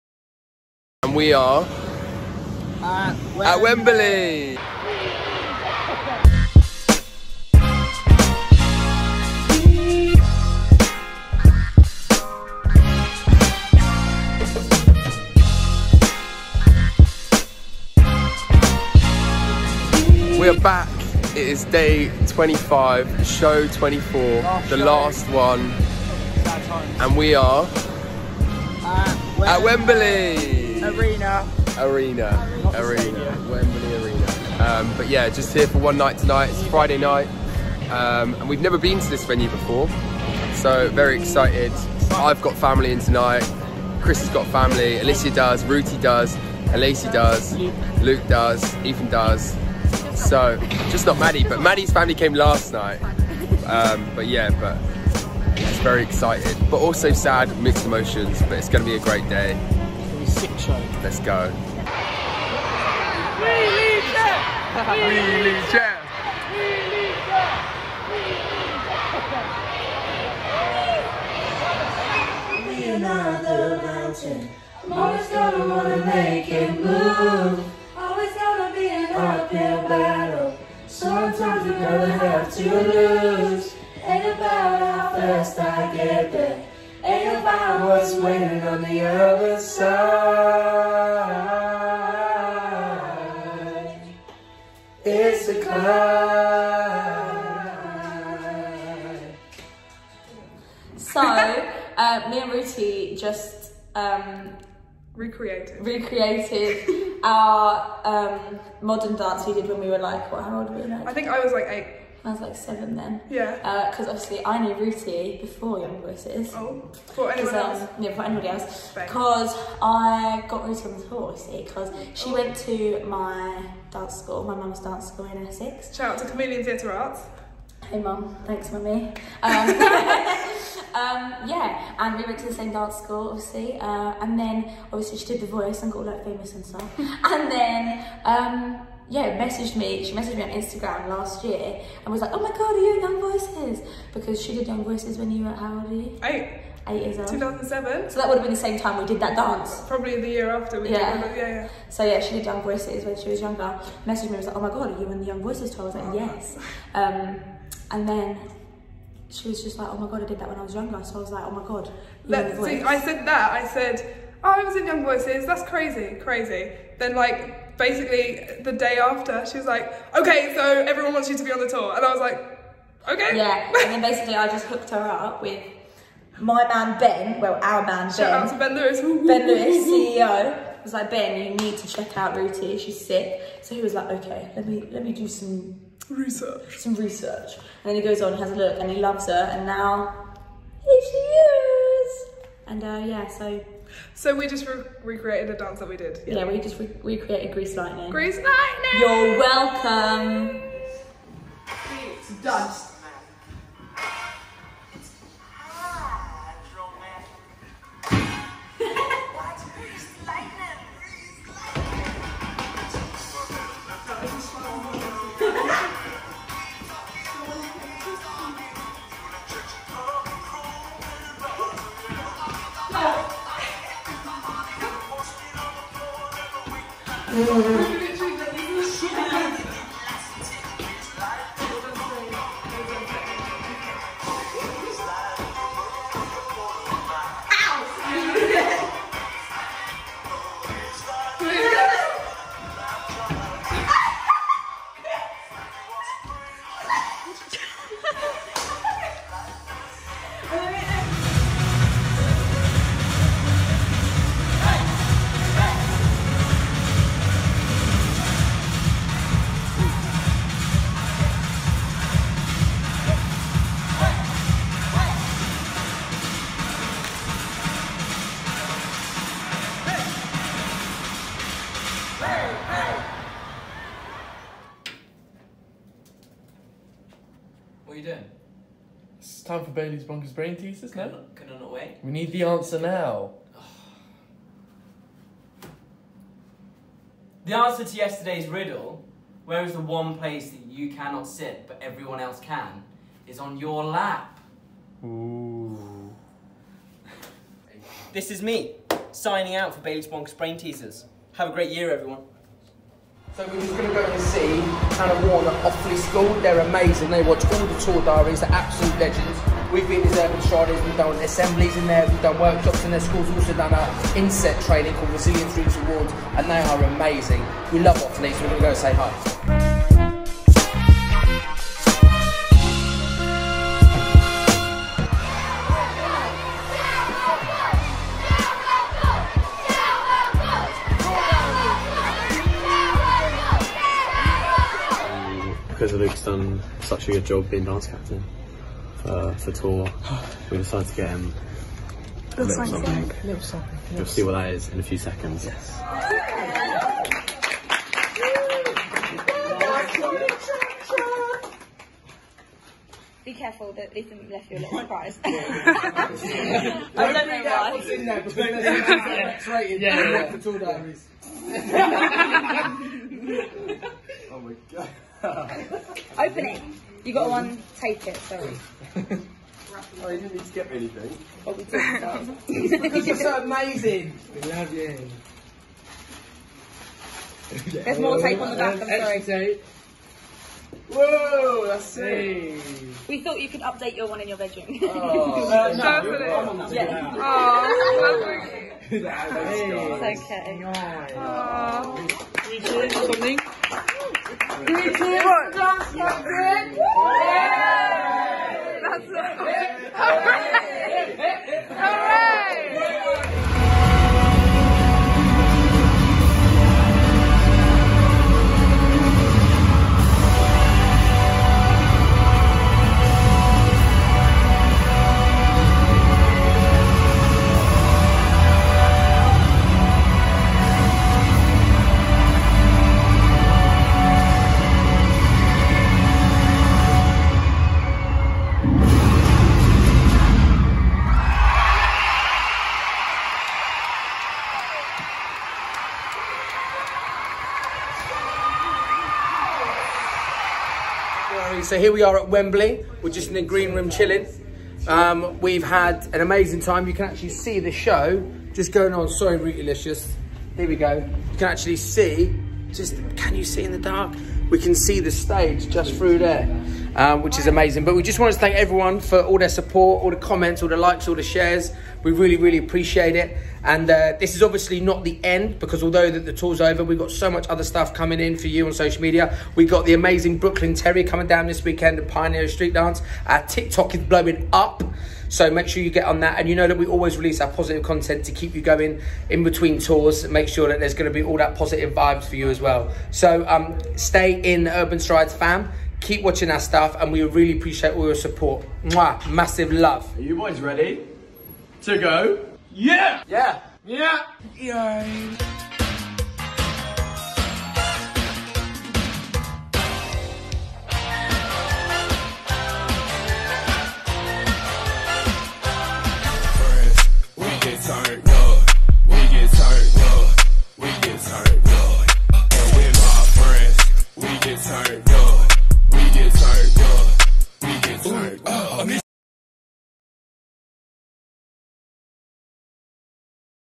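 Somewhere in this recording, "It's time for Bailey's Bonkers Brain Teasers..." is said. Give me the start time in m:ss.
4:39.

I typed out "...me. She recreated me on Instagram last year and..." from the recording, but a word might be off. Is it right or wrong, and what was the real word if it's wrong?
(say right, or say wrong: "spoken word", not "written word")
wrong: "messaged", not "recreated".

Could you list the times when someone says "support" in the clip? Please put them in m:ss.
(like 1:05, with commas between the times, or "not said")
7:39, 8:08.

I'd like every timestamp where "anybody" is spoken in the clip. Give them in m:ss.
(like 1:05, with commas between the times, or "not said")
1:58.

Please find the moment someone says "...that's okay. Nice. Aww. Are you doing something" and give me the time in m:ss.
6:29.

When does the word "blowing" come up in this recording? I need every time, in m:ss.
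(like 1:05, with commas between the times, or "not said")
7:54.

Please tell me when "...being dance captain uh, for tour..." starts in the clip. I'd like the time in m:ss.
5:37.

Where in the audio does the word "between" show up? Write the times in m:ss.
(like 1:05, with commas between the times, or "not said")
5:58, 7:59.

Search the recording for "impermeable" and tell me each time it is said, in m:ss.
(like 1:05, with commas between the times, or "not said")
not said.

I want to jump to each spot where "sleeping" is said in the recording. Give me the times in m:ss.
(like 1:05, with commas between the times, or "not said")
not said.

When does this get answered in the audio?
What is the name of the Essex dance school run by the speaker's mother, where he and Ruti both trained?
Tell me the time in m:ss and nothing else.
2:06.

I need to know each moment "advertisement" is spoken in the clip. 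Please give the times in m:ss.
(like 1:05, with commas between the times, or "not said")
not said.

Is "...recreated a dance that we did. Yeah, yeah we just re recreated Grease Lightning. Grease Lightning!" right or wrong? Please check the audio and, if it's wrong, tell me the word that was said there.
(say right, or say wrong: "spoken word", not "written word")
right.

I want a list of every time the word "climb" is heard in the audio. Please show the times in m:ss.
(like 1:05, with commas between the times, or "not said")
1:35.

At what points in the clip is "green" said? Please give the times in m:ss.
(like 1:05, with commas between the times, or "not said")
7:23.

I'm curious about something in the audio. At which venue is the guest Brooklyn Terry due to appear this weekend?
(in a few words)
Pioneer Street Dance.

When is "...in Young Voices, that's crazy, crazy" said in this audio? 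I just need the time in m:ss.
2:44.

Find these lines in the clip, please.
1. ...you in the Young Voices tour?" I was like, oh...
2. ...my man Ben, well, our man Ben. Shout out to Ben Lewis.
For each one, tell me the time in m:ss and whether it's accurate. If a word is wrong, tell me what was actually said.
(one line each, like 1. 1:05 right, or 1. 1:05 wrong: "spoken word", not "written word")
1. 2:35 right
2. 2:56 right.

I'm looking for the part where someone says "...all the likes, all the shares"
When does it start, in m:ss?
7:40.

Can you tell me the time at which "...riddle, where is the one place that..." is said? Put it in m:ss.
4:48.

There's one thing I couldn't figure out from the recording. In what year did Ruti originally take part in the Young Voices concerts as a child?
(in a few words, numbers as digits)
2007.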